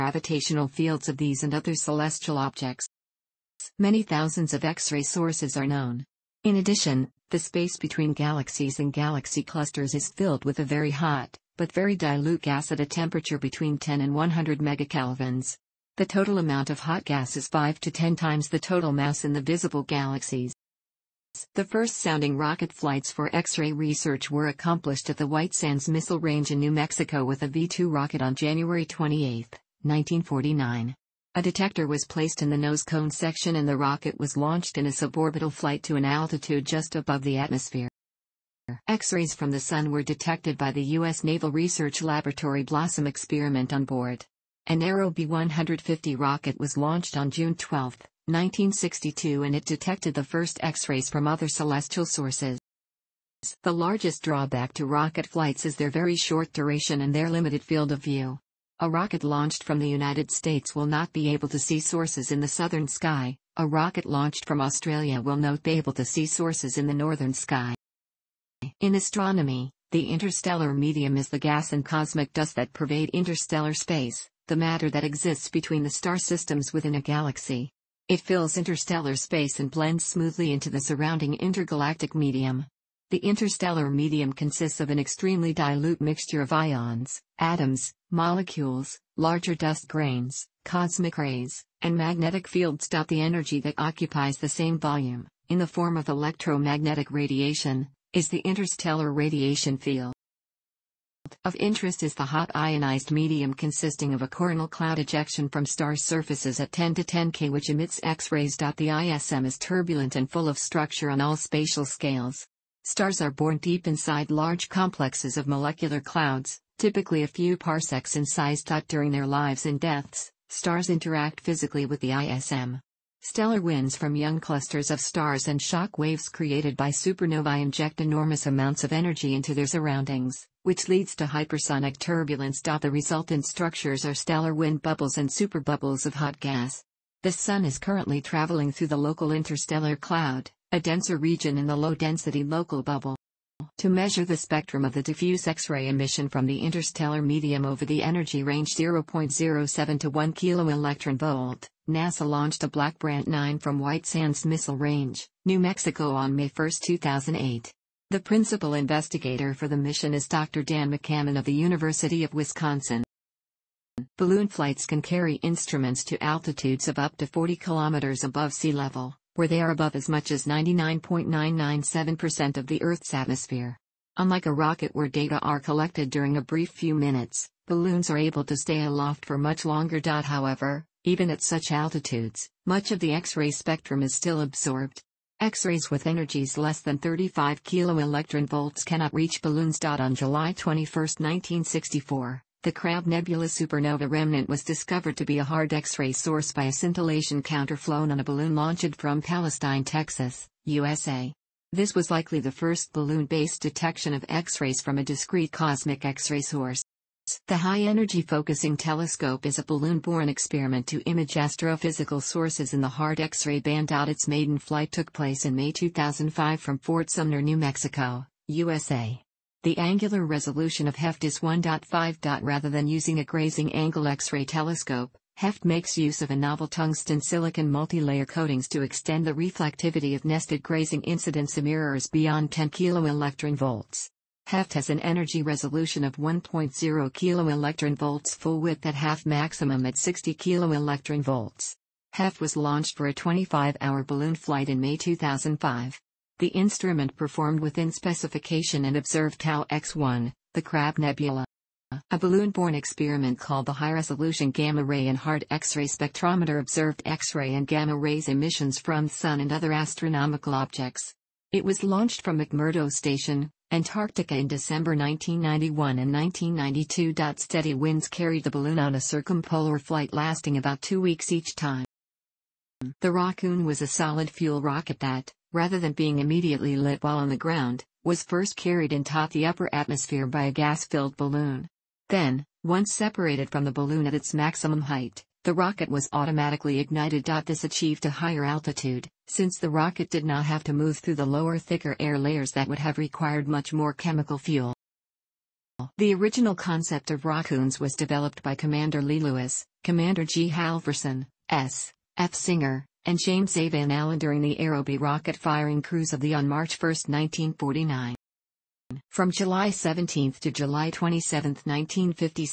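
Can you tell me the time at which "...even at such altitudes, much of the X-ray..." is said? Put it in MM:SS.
03:01.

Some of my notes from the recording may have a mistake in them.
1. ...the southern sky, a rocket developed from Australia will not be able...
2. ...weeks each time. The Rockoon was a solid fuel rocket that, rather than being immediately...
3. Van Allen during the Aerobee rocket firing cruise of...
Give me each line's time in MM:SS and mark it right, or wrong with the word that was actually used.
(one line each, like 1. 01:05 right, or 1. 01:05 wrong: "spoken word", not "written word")
1. 01:02 wrong: "launched", not "developed"
2. 04:30 right
3. 05:03 right.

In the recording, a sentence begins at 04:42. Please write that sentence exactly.
Then, once separated from the balloon at its maximum height, the rocket was automatically ignited.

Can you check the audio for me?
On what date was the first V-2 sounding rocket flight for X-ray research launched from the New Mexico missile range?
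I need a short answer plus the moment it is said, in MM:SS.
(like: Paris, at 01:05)
January 28, 1949, at 00:28.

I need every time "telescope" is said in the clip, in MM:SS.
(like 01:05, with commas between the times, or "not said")
03:28, 03:44.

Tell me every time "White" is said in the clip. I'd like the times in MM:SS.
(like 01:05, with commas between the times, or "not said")
00:25, 02:33.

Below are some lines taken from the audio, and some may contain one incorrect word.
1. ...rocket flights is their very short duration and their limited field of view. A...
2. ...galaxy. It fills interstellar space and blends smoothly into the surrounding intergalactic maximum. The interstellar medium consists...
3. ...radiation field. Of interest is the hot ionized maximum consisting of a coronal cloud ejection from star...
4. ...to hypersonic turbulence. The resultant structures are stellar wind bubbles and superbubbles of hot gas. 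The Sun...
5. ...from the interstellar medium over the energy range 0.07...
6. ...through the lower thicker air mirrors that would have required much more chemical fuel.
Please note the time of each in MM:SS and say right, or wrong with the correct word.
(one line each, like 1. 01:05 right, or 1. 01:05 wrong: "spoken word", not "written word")
1. 00:54 right
2. 01:17 wrong: "medium", not "maximum"
3. 01:39 wrong: "medium", not "maximum"
4. 02:11 right
5. 02:26 right
6. 04:50 wrong: "layers", not "mirrors".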